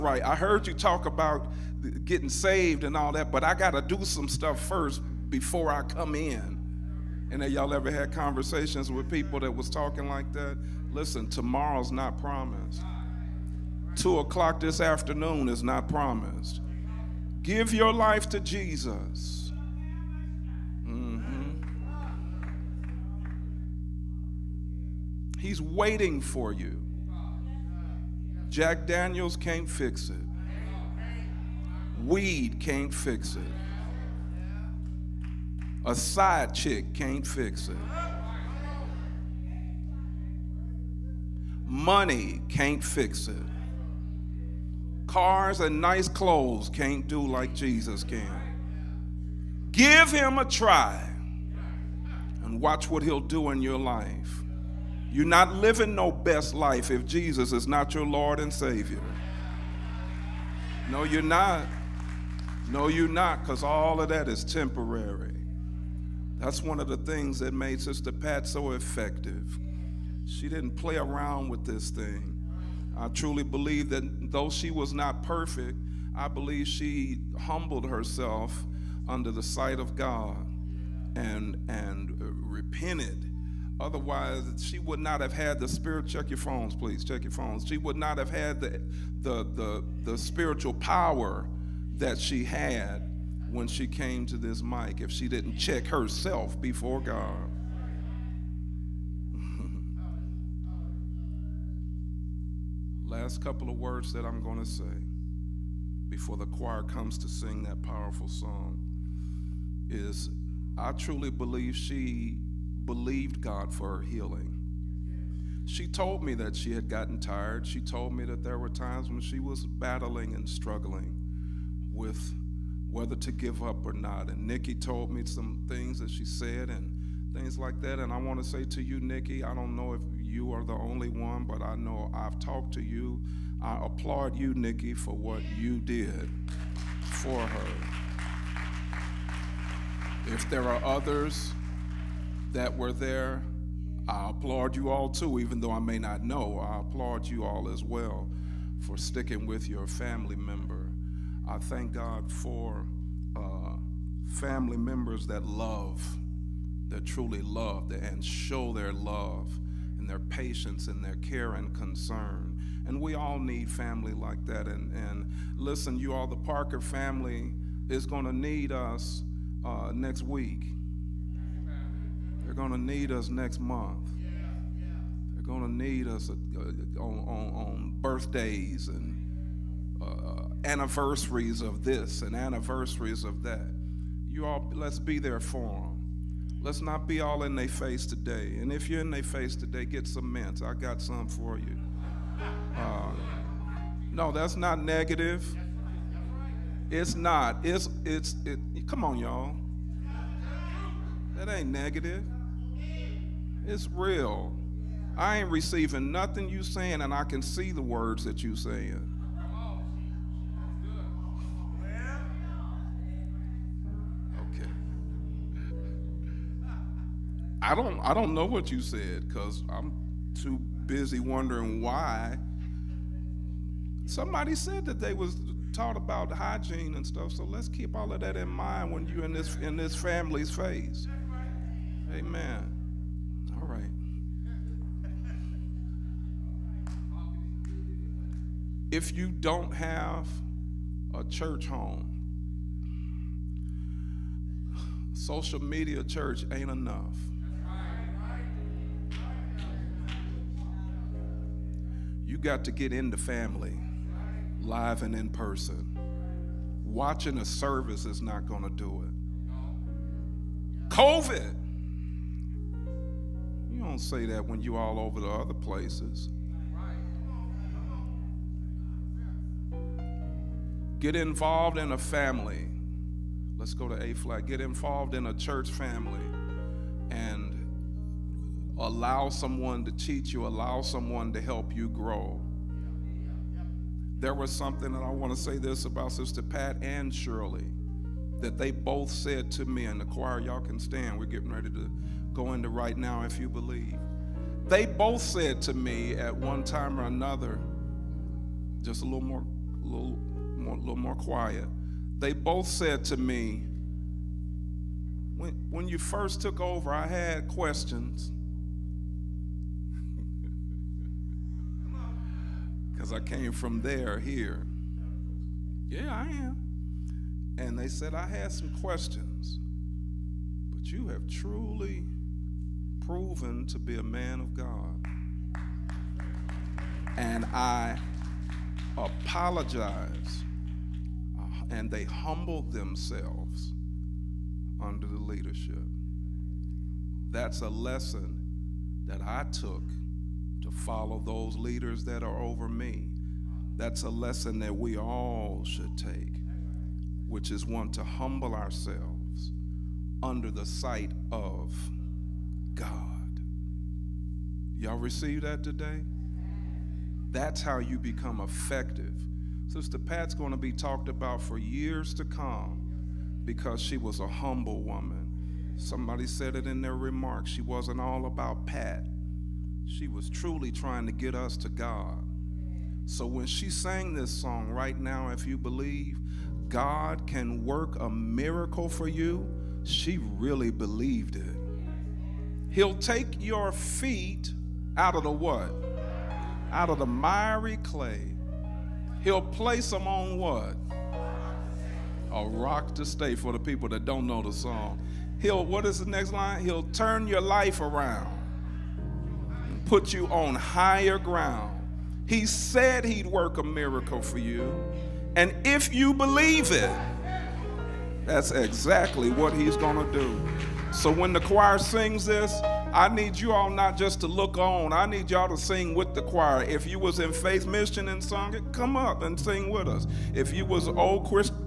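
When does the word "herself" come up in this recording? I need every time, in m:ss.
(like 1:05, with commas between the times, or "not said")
1:17, 1:35.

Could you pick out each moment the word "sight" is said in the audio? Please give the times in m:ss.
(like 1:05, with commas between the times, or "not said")
1:19, 5:50.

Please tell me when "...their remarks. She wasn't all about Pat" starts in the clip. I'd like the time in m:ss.
6:06.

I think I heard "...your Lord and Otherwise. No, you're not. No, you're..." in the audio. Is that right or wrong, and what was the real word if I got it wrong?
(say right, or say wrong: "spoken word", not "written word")
wrong: "Savior", not "Otherwise".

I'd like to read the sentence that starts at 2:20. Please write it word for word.
If there are others, that were there.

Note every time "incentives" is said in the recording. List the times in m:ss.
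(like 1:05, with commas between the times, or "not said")
not said.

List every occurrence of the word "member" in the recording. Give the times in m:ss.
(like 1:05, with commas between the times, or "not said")
2:30, 2:34.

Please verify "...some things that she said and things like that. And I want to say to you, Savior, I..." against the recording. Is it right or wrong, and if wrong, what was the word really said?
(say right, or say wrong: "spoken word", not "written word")
wrong: "Nikki", not "Savior".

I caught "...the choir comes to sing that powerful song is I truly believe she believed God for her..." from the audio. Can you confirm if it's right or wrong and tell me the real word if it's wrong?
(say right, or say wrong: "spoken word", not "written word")
right.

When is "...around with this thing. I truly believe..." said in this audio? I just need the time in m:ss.
1:10.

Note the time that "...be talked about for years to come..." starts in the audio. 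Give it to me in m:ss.
6:00.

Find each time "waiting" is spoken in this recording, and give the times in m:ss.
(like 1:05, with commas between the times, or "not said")
0:25.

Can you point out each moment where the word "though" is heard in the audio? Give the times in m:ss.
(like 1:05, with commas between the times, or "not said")
1:14, 2:25.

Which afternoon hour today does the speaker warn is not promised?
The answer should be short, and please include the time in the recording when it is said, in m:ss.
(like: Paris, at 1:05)
2 o'clock, at 0:13.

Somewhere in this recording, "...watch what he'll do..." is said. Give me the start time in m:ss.
0:52.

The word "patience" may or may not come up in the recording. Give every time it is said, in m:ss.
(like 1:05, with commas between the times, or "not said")
2:40.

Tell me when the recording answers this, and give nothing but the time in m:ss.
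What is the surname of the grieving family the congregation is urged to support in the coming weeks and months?
2:46.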